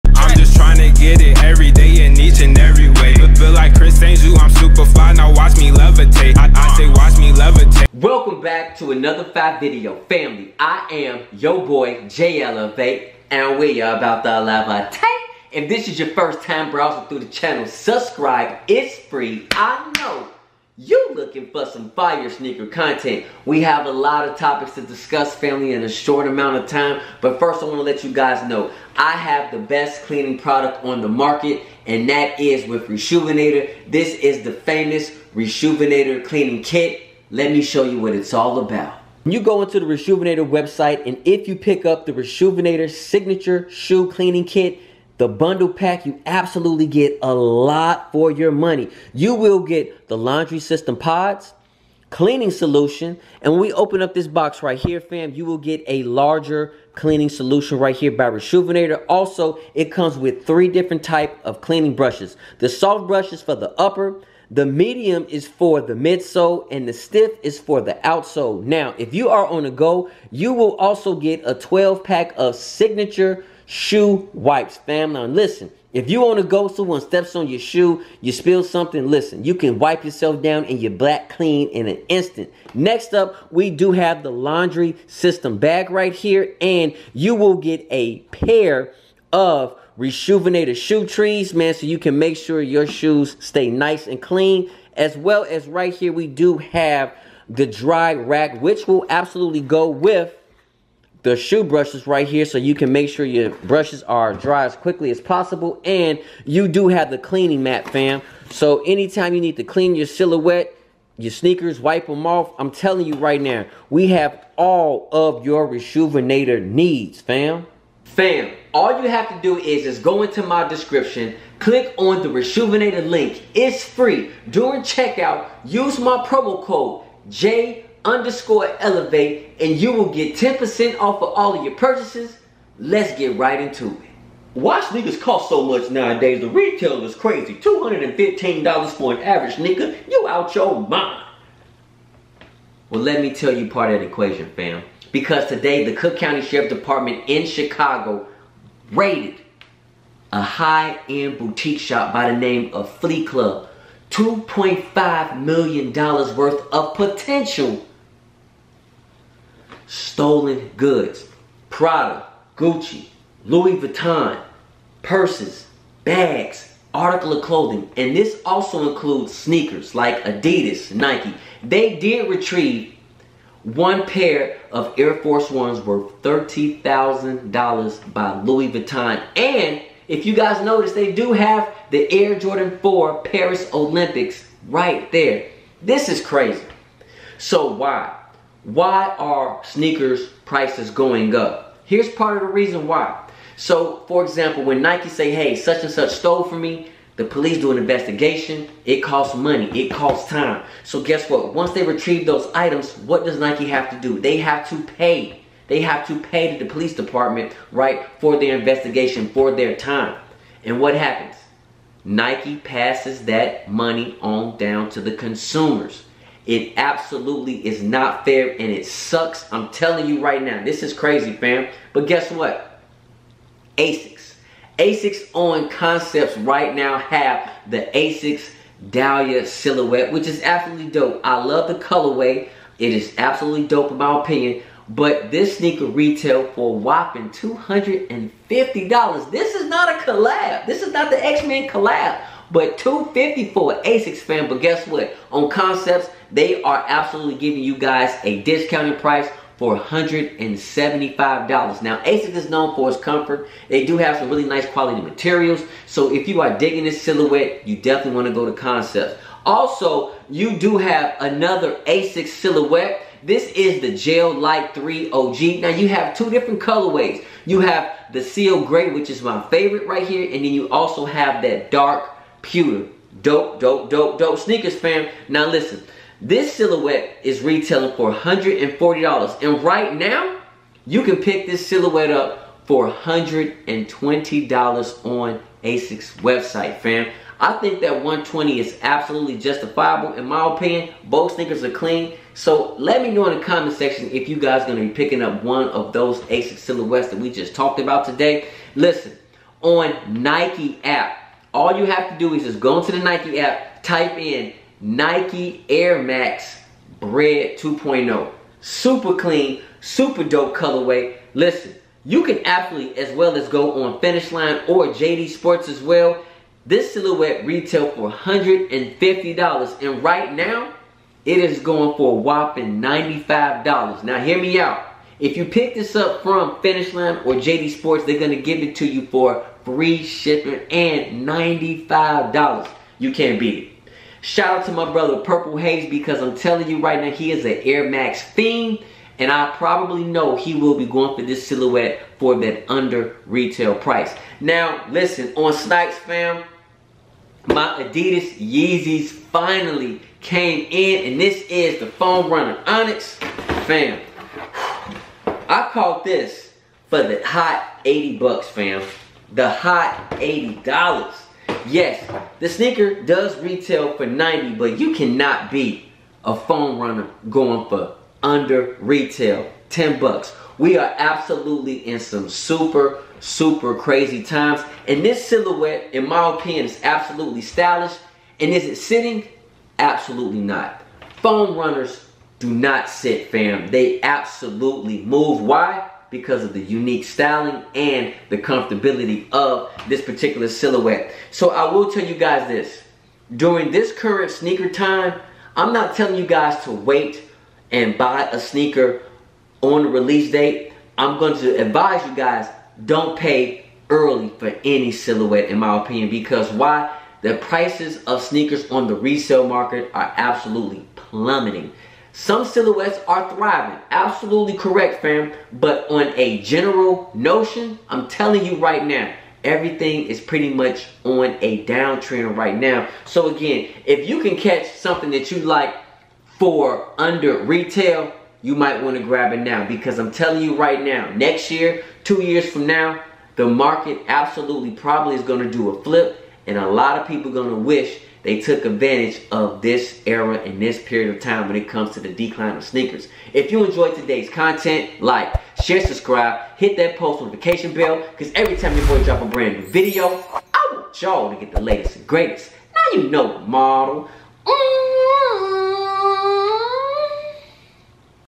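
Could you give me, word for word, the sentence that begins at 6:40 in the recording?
I'm going to advise you guys don't pay early for any silhouette in my opinion because why?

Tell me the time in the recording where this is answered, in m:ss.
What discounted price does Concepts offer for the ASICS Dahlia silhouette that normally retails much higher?
4:09.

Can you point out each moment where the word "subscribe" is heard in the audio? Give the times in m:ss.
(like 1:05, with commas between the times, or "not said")
0:17, 7:25.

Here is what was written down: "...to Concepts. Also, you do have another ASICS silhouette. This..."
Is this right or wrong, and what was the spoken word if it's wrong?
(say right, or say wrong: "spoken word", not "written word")
right.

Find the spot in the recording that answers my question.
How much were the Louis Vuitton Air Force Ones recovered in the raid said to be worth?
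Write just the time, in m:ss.
2:56.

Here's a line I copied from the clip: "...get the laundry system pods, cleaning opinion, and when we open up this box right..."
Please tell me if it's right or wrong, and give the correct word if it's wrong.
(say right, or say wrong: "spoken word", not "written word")
wrong: "solution", not "opinion".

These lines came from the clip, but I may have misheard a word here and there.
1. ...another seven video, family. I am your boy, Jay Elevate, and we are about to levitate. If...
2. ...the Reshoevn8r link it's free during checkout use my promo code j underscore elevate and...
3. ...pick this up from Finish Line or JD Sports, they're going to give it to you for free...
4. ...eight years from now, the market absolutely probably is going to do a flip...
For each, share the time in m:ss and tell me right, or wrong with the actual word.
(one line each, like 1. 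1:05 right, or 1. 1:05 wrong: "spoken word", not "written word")
1. 0:08 wrong: "five", not "seven"
2. 2:02 right
3. 5:25 right
4. 7:12 wrong: "two", not "eight".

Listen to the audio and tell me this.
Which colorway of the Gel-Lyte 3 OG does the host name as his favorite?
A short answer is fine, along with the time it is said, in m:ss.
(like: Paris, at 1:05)
Seal Gray, at 4:28.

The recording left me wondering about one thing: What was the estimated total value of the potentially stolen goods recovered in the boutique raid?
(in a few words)
$2.5 million.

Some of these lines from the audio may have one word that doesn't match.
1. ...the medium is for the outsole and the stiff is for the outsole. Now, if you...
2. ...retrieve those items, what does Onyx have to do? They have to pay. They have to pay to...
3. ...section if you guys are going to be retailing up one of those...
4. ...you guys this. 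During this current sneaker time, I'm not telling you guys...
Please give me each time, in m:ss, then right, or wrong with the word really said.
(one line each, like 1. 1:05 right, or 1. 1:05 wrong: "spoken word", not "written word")
1. 1:04 wrong: "midsole", not "outsole"
2. 3:21 wrong: "Nike", not "Onyx"
3. 4:53 wrong: "picking", not "retailing"
4. 6:32 right.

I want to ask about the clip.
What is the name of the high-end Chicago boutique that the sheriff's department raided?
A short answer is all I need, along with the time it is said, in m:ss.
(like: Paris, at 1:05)
Flee Club, at 2:32.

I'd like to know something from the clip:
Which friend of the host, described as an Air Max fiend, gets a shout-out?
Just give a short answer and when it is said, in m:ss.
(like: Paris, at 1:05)
Purple Haze, at 5:35.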